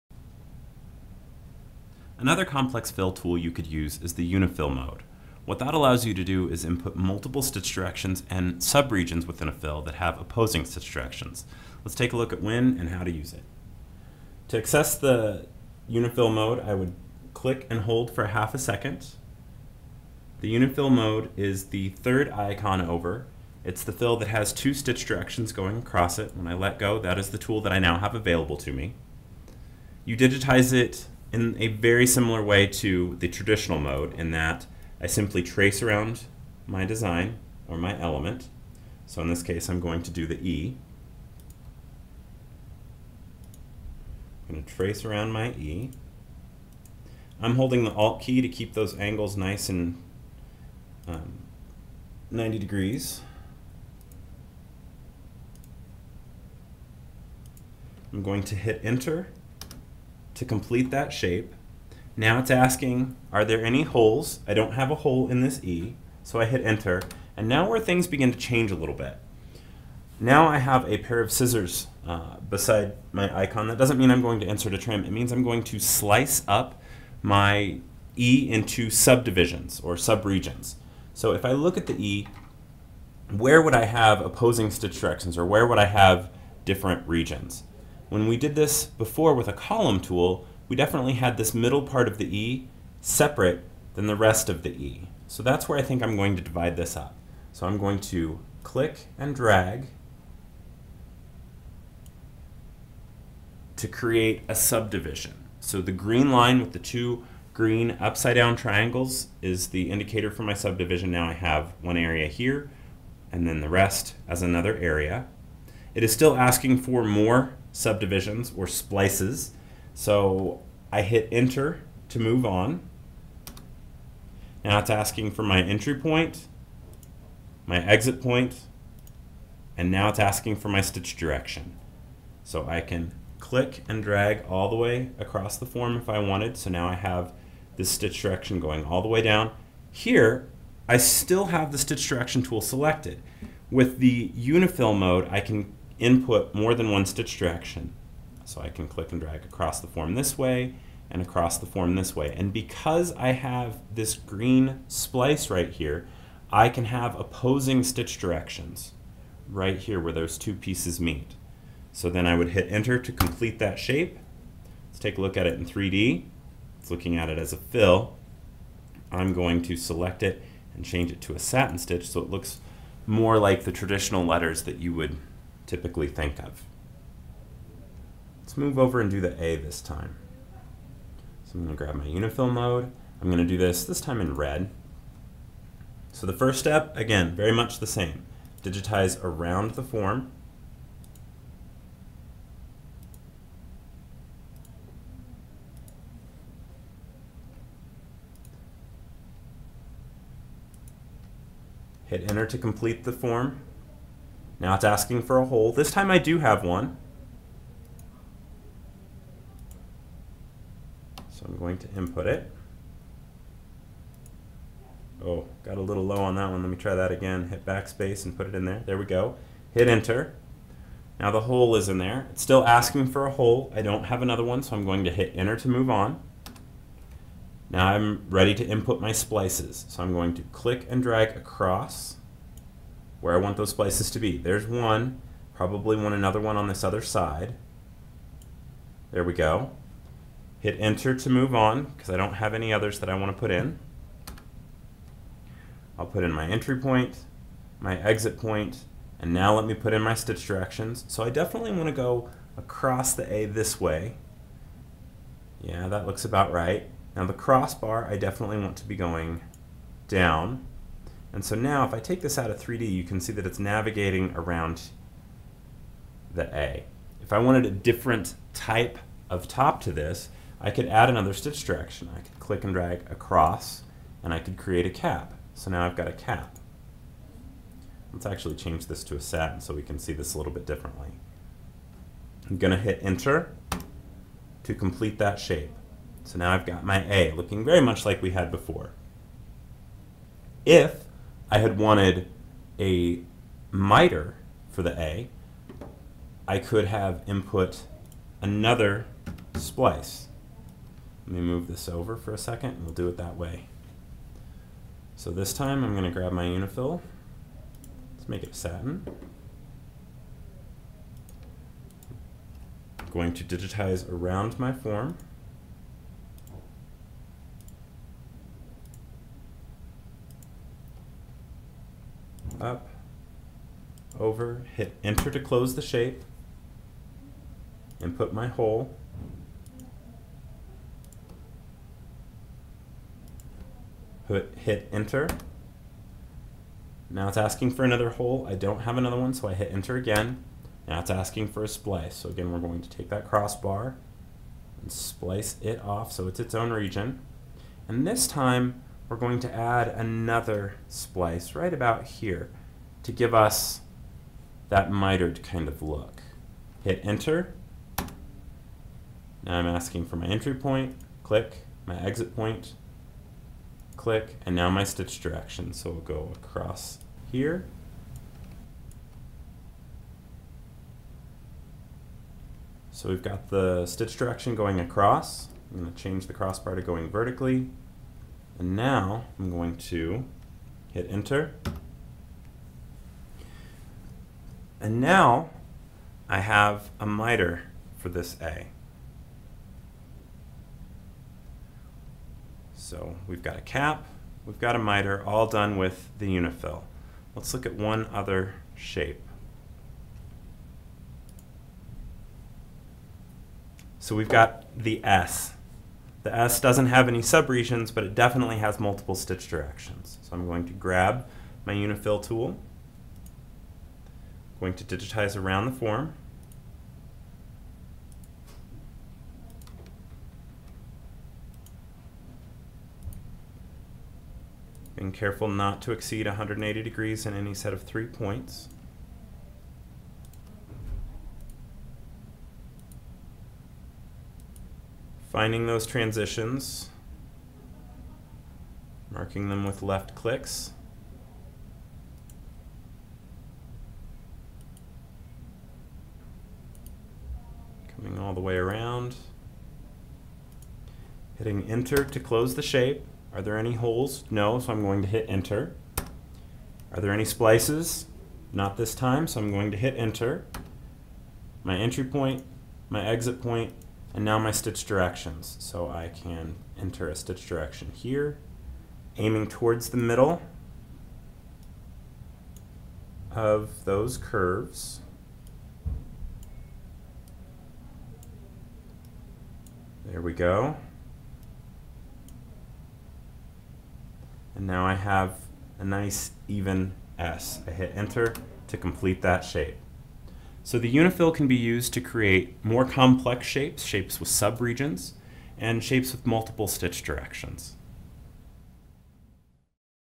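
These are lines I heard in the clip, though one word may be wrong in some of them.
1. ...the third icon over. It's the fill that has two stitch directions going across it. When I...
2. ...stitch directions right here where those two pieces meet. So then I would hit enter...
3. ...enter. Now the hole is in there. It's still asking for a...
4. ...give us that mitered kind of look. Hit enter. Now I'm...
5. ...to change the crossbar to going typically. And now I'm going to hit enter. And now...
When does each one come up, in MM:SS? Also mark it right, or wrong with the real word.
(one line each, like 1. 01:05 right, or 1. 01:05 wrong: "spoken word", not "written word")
1. 00:21 right
2. 02:37 right
3. 03:39 right
4. 05:53 right
5. 06:15 wrong: "vertically", not "typically".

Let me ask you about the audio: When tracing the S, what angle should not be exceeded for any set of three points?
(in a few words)
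180 degrees.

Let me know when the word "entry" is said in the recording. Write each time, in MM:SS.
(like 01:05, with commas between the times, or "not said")
02:05, 04:06, 06:00, 07:41.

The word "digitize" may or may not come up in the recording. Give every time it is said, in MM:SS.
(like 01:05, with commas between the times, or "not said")
00:30, 03:08, 05:13, 06:54.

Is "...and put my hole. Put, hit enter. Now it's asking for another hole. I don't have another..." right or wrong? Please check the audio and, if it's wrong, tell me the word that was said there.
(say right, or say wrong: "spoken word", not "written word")
right.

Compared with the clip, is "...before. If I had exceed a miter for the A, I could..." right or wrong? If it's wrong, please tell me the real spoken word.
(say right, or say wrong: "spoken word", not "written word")
wrong: "wanted", not "exceed".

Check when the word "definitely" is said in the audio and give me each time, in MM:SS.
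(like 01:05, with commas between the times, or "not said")
01:30, 04:11, 04:18, 06:48.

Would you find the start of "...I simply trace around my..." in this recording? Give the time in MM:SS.
00:34.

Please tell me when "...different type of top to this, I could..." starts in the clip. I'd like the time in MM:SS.
04:27.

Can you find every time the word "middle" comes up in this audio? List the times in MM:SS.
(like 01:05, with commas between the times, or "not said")
01:31, 07:49.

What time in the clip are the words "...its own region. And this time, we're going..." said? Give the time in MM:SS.
05:46.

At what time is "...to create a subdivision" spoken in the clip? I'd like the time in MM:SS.
01:43.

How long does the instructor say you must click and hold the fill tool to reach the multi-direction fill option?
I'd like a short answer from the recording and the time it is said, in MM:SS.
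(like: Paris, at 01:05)
half a second, at 00:18.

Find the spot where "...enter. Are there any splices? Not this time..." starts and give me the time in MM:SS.
07:35.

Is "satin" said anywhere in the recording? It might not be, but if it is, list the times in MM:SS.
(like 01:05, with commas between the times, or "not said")
02:51, 04:39, 05:08.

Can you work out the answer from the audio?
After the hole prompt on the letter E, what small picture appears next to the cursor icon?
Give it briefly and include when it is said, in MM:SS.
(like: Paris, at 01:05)
scissors, at 01:10.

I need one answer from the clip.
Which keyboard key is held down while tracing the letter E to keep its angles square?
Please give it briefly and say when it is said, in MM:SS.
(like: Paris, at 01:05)
Alt, at 00:47.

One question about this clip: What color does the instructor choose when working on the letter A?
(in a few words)
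red.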